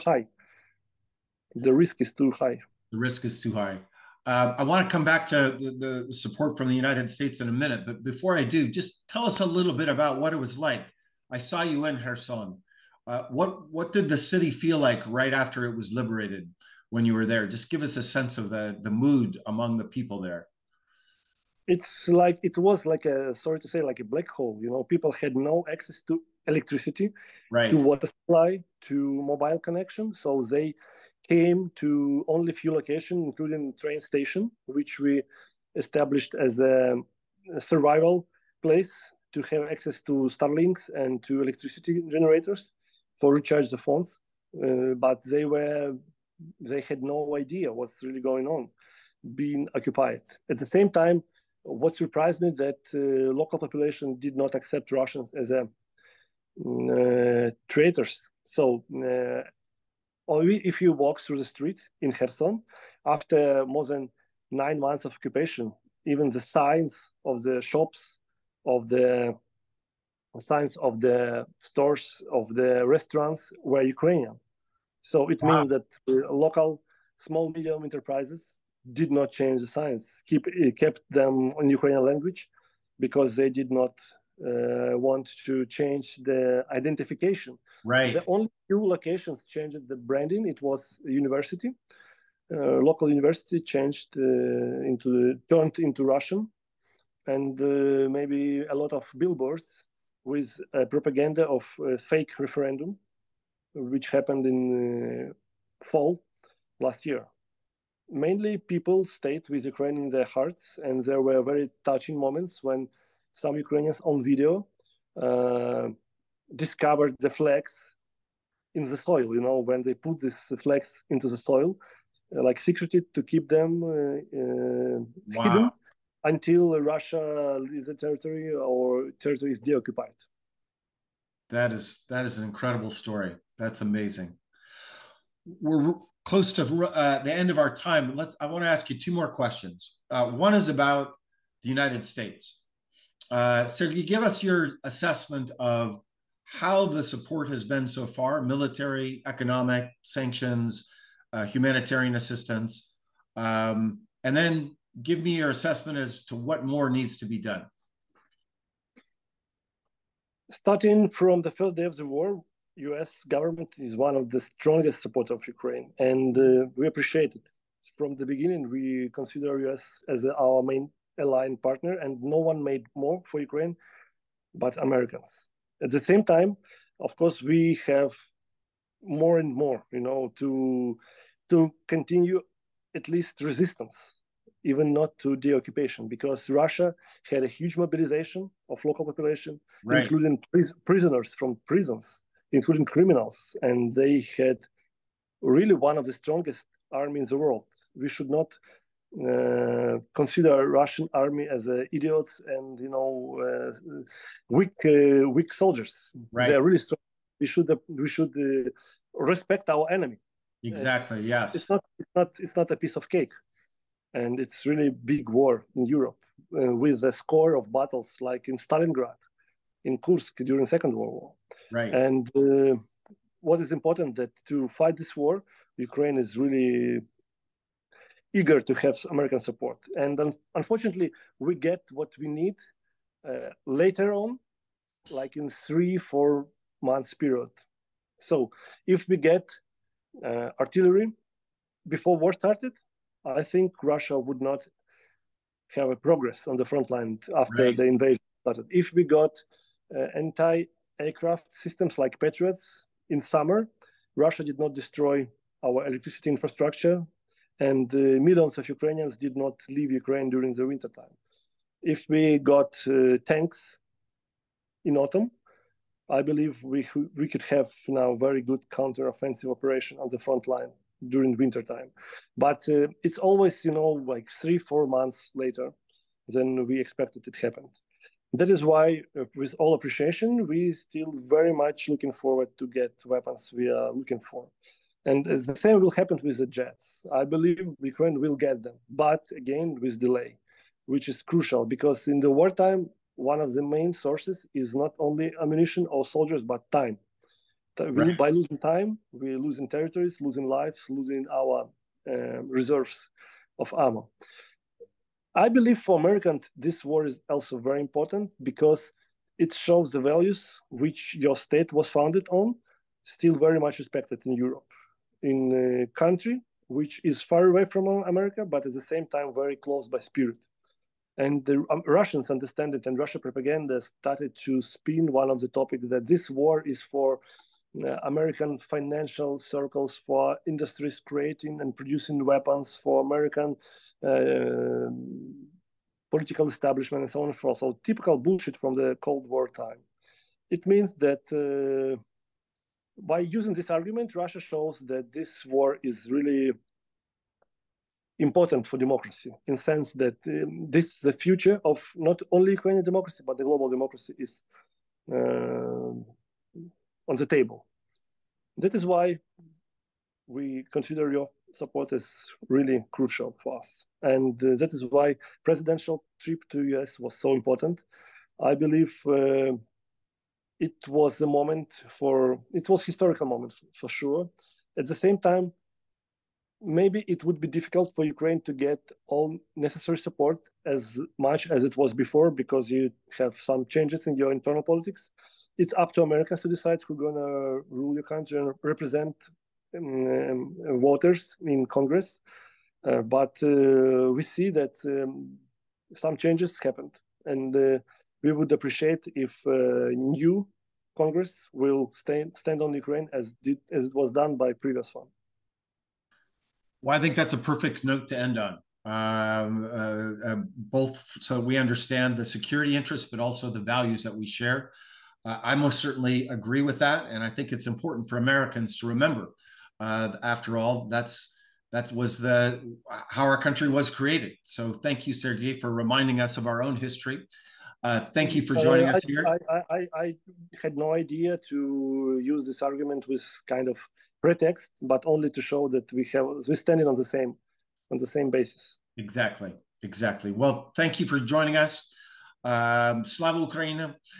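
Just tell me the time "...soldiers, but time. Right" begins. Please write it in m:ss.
4:56.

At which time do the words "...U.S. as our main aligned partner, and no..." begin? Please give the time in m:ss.
2:49.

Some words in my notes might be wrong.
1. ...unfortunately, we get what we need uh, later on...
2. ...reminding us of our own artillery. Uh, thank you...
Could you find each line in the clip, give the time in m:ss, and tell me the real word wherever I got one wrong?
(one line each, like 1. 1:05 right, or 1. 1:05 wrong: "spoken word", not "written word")
1. 3:50 right
2. 7:05 wrong: "history", not "artillery".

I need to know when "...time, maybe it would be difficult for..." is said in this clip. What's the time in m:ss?
6:15.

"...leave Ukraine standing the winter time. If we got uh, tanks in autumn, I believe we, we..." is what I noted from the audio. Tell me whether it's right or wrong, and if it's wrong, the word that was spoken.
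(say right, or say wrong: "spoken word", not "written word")
wrong: "during", not "standing".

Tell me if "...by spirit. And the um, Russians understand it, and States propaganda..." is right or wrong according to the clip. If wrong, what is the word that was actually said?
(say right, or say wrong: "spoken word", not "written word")
wrong: "Russian", not "States".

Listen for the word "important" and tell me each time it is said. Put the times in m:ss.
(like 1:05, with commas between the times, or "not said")
3:43, 5:07, 5:48, 6:07, 6:57.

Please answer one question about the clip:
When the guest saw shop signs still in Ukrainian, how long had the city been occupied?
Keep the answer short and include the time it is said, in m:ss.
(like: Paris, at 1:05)
more than 9 months, at 1:03.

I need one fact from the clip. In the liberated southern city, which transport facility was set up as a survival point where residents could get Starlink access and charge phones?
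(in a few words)
train station.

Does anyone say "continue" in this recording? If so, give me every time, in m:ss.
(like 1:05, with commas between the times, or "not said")
3:01.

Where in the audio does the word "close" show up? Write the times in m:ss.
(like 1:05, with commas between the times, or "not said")
2:16, 5:19.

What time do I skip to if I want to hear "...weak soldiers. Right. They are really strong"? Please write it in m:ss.
3:25.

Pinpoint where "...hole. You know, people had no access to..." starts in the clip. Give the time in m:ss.
0:24.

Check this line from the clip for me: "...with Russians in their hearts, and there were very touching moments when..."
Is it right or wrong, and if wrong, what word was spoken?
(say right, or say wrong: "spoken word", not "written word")
wrong: "Ukraine", not "Russians".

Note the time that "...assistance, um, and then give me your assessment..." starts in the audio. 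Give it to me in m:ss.
2:32.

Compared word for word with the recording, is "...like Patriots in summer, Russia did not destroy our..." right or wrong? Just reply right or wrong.
right.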